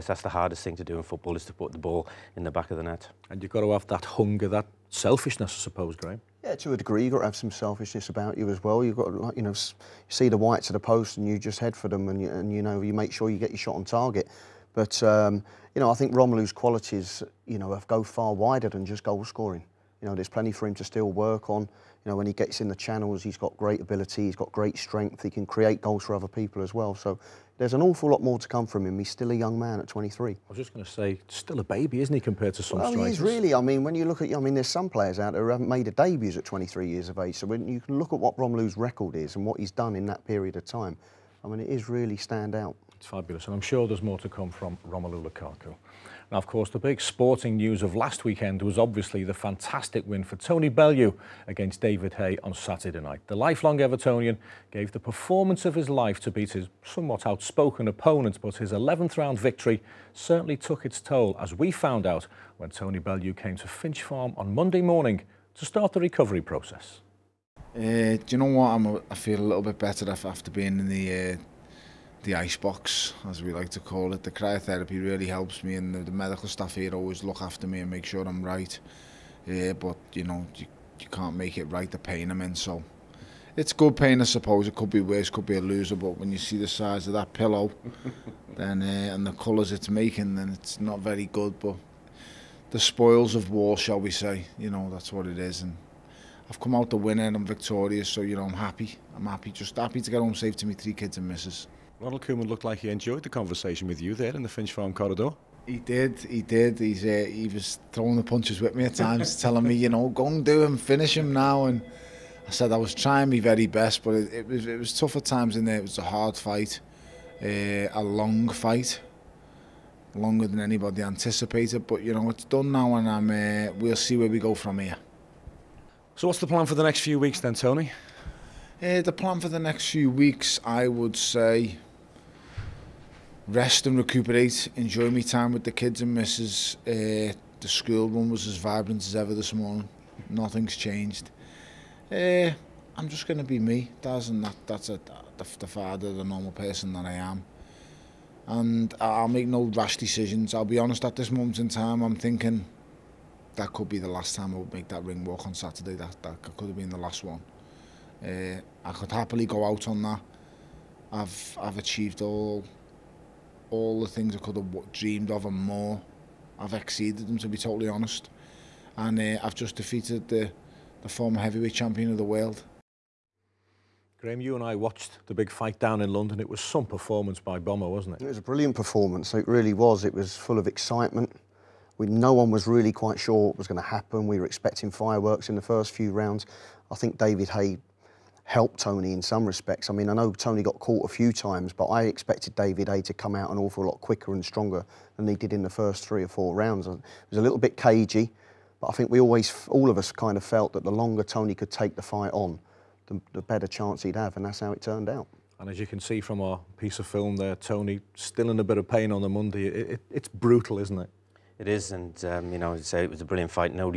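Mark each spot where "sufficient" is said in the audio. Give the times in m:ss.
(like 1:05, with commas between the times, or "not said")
not said.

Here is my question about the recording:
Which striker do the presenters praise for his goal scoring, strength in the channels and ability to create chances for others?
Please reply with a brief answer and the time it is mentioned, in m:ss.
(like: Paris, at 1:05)
Romelu Lukaku, at 0:44.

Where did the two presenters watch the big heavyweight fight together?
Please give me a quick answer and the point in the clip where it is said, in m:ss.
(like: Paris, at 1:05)
London, at 2:56.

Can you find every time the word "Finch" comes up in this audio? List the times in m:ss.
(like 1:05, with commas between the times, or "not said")
1:03, 1:44.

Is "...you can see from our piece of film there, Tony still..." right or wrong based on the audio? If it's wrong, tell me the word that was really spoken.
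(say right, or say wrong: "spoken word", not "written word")
right.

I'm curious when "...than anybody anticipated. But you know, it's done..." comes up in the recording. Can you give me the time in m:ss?
2:00.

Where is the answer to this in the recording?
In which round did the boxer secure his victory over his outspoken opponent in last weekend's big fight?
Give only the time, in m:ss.
0:58.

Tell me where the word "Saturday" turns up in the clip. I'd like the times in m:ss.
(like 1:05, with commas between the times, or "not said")
0:52, 2:35.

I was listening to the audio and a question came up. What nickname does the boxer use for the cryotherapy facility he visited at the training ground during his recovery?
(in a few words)
the ice box.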